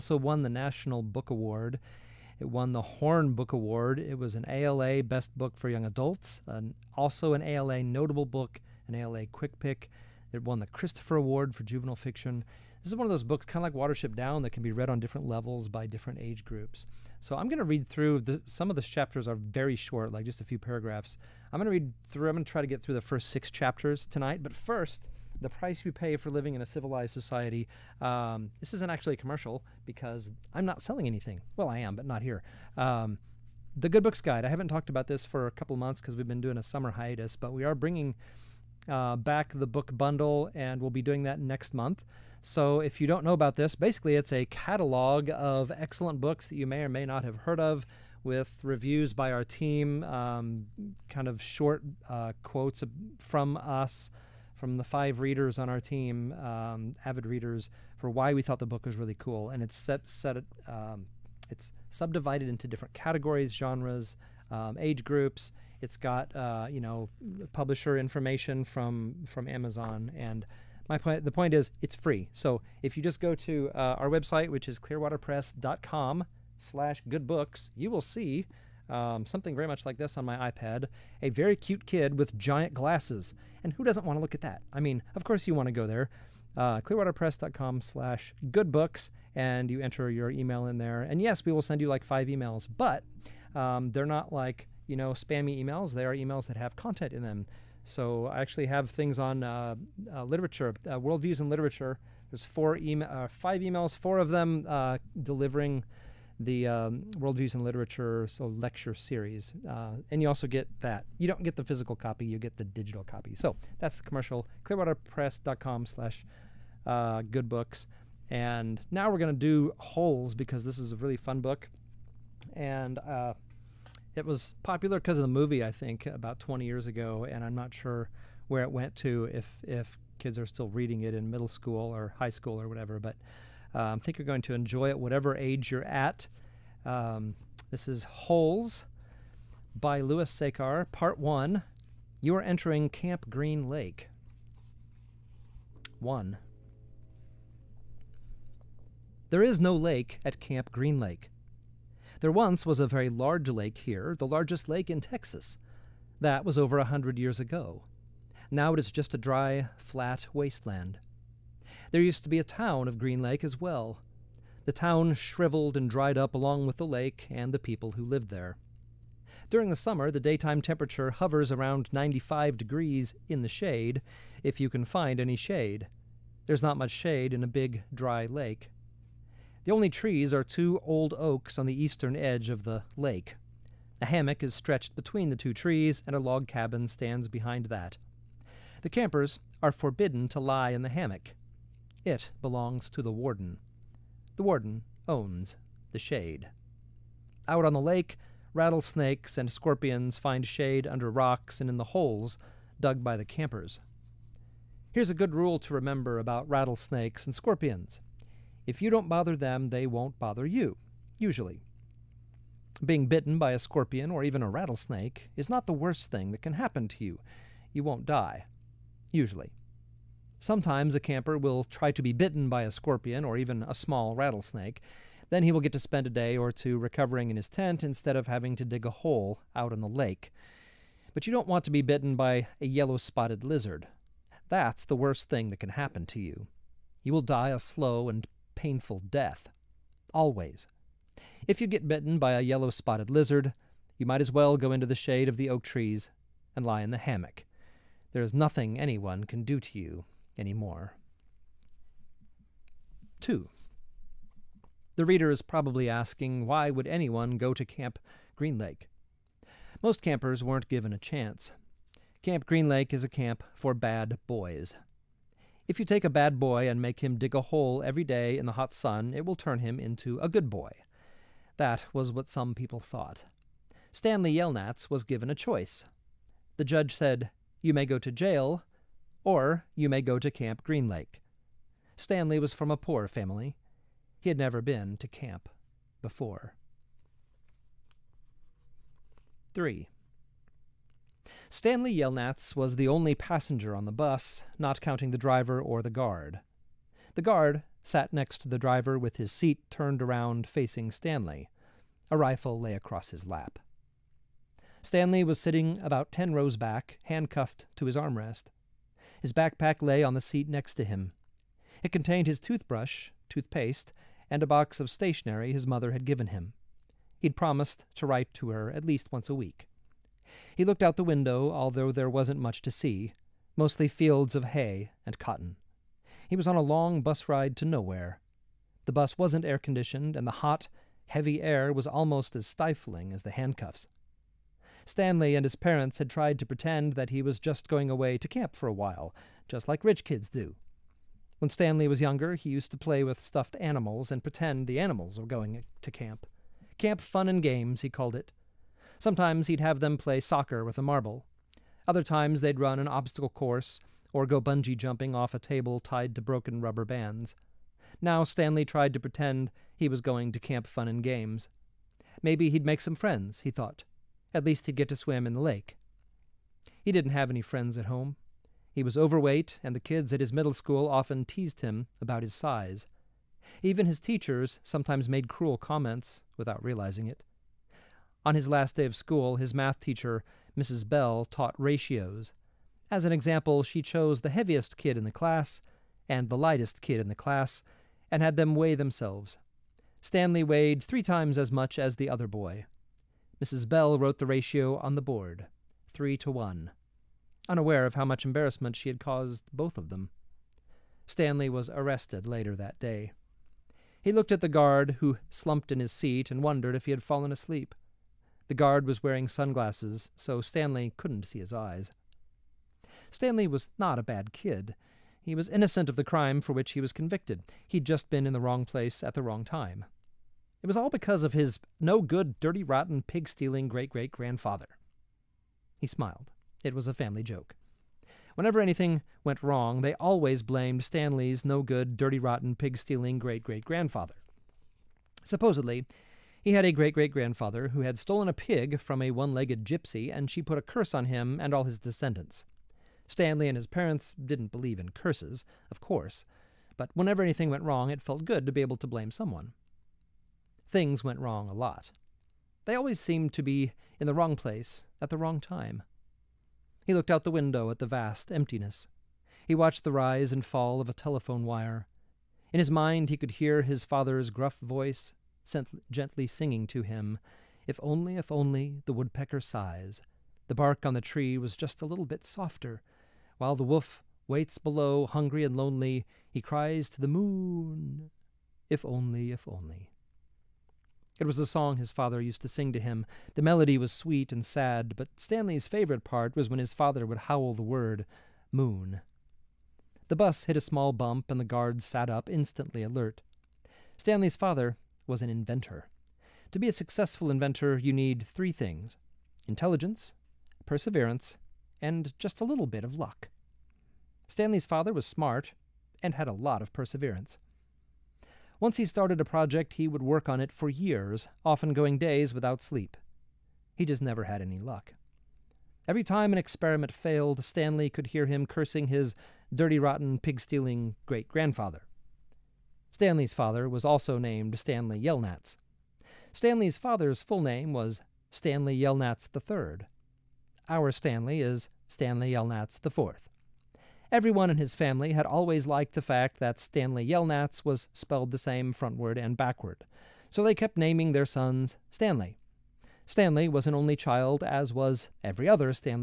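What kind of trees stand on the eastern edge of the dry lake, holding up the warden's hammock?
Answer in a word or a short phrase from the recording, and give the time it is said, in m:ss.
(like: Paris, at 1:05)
Oaks, at 3:01.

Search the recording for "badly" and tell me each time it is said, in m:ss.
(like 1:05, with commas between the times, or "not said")
not said.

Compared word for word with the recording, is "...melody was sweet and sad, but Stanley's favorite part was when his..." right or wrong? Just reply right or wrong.
right.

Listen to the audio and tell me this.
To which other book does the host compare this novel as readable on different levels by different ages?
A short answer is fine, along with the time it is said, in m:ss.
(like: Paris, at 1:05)
Watership Down, at 0:13.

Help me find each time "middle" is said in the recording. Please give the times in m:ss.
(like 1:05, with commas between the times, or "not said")
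2:11, 6:10.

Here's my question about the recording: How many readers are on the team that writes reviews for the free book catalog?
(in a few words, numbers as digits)
5.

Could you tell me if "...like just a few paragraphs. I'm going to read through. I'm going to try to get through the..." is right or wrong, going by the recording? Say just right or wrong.
right.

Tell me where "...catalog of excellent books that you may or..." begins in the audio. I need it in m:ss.
0:44.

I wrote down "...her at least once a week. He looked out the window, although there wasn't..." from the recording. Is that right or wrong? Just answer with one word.
right.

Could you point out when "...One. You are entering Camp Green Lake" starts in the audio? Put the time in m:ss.
2:21.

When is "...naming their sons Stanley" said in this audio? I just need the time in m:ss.
9:00.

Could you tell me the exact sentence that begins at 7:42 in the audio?
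In his mind, he could hear his father's gruff voice gently singing to him, If only, if only, the woodpecker sighs.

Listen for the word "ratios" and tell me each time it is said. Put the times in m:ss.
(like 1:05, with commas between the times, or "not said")
6:21, 6:34.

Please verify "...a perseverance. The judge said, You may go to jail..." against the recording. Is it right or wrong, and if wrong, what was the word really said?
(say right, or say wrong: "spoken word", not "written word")
wrong: "choice", not "perseverance".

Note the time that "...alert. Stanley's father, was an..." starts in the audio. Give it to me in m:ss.
8:12.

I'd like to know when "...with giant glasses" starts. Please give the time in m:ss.
1:22.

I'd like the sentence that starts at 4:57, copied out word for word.
The guard sat next to the driver with his seat turned around facing Stanley.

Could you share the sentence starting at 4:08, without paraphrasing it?
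There is nothing anyone can do to you any more.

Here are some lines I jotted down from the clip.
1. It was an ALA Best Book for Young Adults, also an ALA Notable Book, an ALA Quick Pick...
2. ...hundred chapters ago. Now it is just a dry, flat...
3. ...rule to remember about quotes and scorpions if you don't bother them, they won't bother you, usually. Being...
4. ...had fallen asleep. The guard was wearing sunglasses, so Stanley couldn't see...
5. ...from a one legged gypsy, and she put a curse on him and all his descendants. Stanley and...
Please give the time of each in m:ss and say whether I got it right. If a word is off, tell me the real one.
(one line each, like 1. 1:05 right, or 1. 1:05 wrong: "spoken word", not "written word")
1. 0:03 right
2. 2:36 wrong: "years", not "chapters"
3. 3:25 wrong: "rattlesnakes", not "quotes"
4. 6:46 right
5. 7:18 right.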